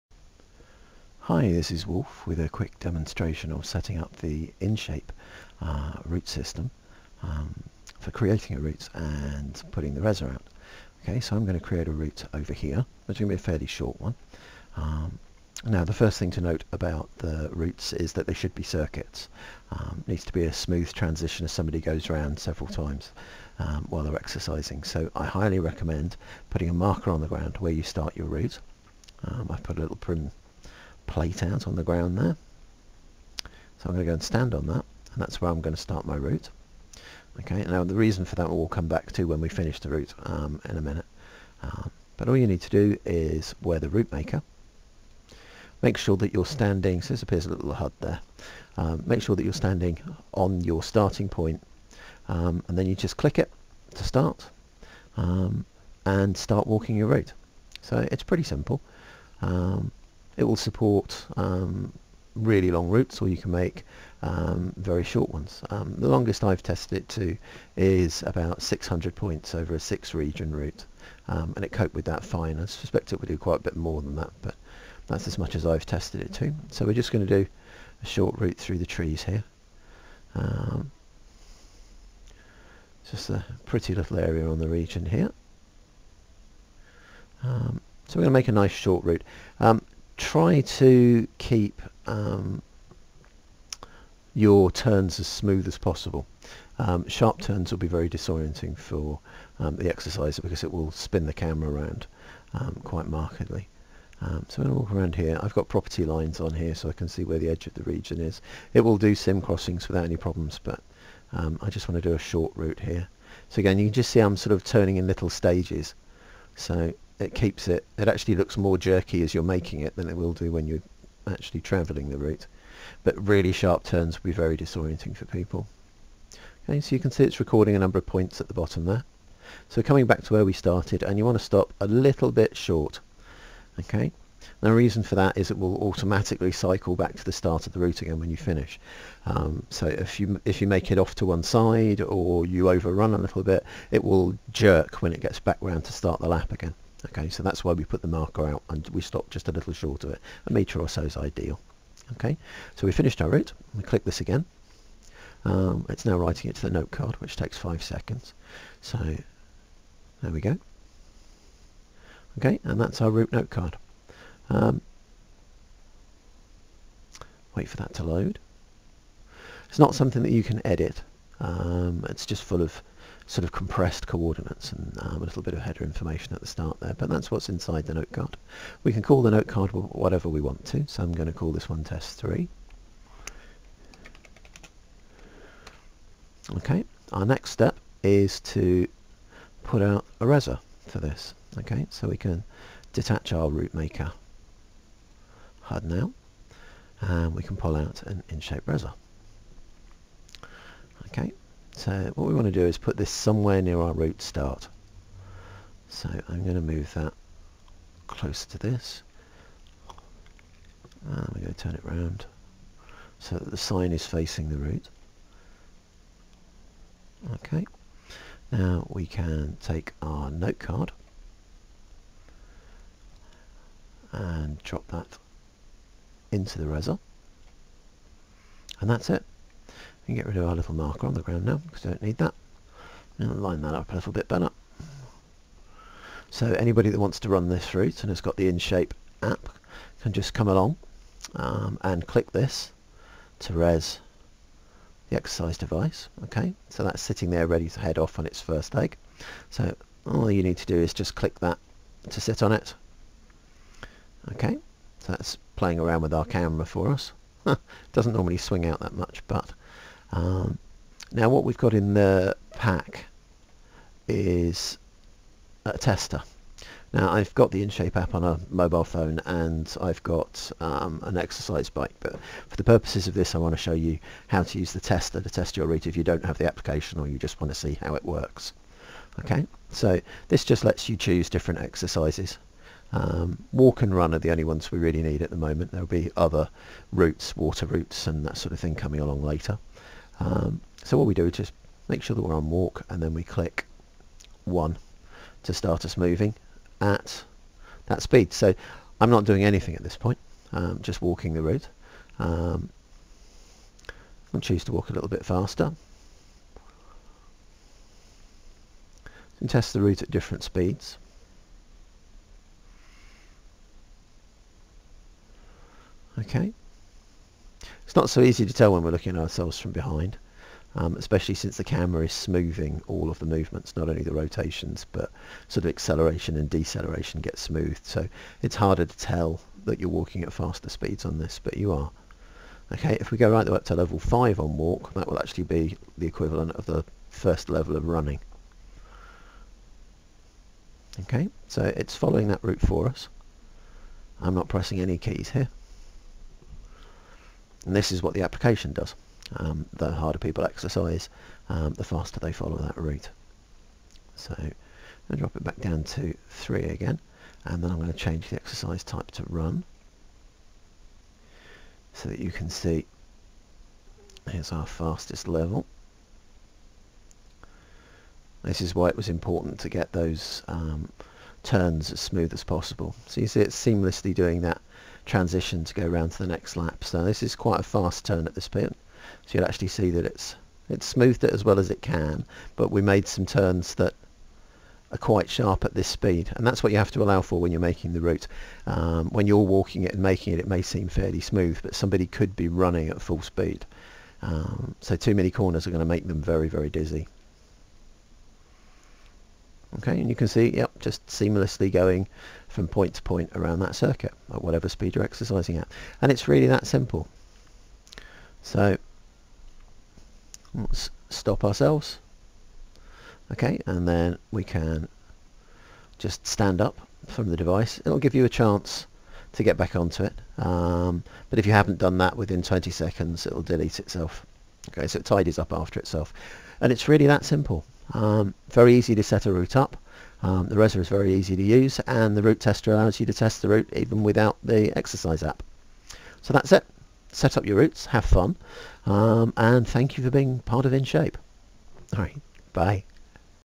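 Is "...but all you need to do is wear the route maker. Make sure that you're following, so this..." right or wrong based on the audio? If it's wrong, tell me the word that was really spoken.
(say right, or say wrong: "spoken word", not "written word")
wrong: "standing", not "following".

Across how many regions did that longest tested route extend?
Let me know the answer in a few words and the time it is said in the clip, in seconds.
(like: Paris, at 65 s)
6, at 69 s.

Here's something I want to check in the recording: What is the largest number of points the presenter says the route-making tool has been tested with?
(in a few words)
600.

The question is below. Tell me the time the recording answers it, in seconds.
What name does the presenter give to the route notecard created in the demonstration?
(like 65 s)
181 s.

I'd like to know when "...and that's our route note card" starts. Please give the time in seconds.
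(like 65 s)
162 s.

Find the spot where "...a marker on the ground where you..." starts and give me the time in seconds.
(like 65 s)
26 s.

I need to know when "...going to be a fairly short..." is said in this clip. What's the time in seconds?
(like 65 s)
13 s.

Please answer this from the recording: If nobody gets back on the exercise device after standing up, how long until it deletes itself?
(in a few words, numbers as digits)
20 seconds.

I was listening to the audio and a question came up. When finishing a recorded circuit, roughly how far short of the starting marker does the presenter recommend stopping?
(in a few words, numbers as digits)
A metre.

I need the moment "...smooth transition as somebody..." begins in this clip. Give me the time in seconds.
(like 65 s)
20 s.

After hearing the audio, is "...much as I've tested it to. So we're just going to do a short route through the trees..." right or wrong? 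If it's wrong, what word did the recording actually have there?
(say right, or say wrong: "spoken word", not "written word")
right.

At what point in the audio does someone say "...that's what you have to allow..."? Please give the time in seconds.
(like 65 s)
386 s.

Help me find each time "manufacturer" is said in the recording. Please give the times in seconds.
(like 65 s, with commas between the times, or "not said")
not said.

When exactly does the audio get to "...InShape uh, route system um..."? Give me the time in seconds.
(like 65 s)
4 s.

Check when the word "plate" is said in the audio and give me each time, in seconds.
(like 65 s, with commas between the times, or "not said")
31 s.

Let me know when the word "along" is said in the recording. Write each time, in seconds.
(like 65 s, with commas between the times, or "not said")
240 s, 288 s.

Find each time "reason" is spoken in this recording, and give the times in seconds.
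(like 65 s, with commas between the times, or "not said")
37 s, 134 s.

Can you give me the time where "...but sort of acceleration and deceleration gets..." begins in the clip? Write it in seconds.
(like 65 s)
324 s.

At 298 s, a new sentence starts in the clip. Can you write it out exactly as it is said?
So I'm not doing anything at this point, um, just walking the route.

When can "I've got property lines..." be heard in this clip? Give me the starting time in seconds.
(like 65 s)
105 s.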